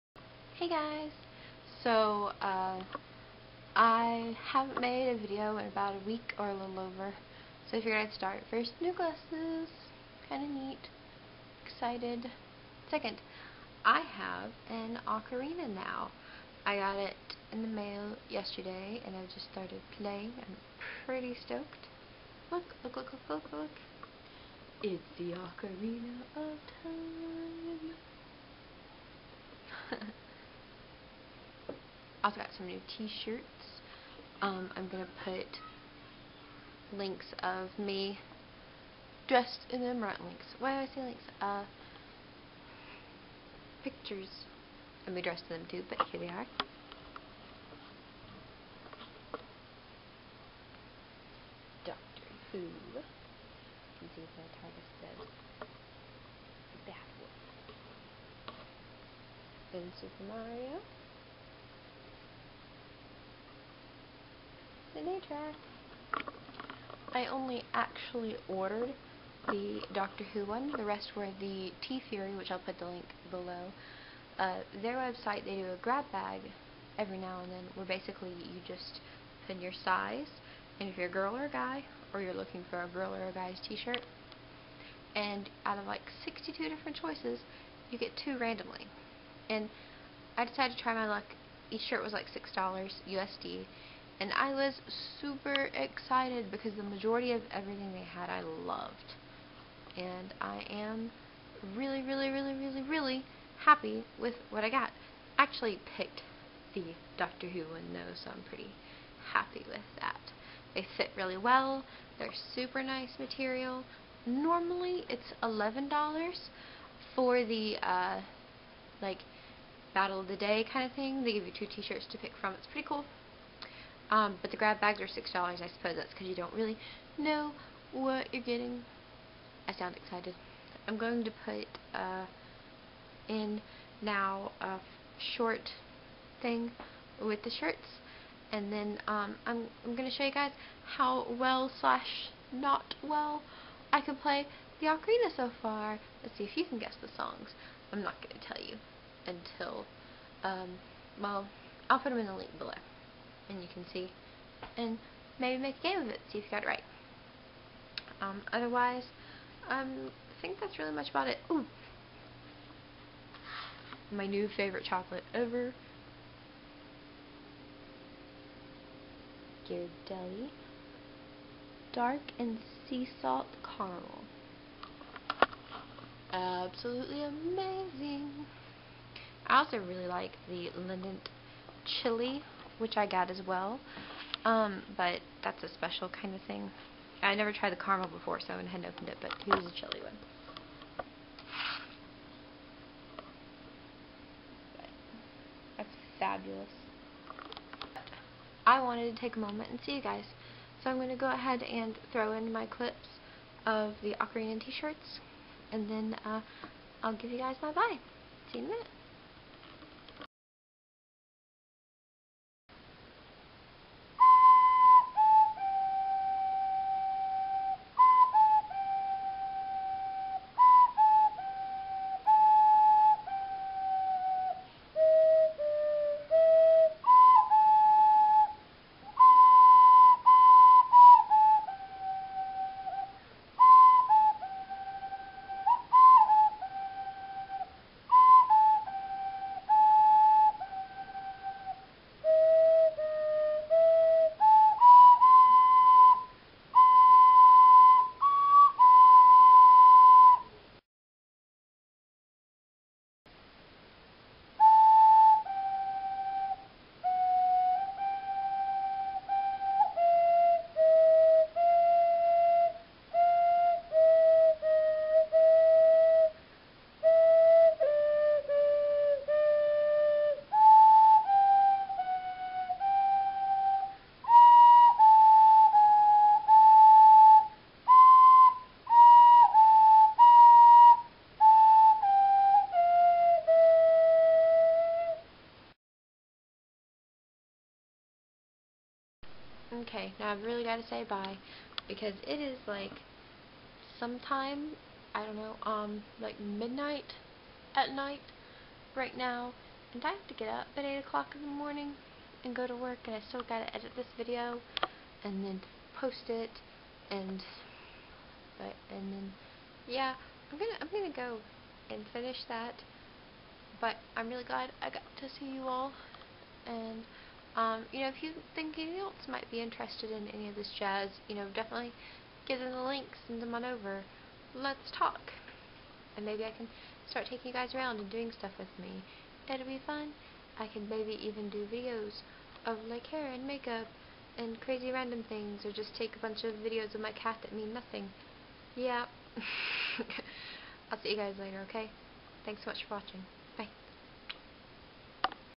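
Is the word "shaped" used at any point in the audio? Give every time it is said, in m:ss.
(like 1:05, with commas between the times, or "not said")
not said.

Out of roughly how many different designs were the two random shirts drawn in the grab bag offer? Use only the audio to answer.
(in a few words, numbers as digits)
62.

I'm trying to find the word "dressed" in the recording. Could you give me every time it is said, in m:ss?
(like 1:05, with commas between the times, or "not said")
0:39, 0:45.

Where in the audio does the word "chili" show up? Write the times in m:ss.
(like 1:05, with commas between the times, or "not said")
3:02, 3:09.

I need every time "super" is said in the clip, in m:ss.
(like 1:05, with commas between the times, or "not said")
1:00, 1:35, 1:52.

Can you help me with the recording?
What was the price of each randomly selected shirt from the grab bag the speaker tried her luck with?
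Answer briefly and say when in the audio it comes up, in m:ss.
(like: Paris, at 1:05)
$6, at 1:32.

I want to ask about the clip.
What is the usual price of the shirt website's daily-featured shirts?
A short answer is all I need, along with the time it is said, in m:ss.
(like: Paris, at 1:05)
$11, at 1:55.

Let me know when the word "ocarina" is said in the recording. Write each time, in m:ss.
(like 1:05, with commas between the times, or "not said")
0:15, 0:25, 2:24, 3:24.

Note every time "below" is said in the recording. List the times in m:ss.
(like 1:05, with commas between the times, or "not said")
1:13, 2:32.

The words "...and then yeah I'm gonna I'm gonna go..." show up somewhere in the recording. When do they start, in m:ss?
5:08.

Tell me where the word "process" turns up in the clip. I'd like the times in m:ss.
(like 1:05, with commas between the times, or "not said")
not said.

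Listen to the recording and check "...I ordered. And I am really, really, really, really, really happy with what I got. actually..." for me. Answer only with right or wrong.
wrong.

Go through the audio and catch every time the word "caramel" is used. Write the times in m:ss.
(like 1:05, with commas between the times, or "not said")
2:53, 3:07.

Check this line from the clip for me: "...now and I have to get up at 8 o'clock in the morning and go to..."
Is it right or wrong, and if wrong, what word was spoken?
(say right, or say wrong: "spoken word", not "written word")
right.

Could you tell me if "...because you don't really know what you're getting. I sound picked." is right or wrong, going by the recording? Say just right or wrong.
wrong.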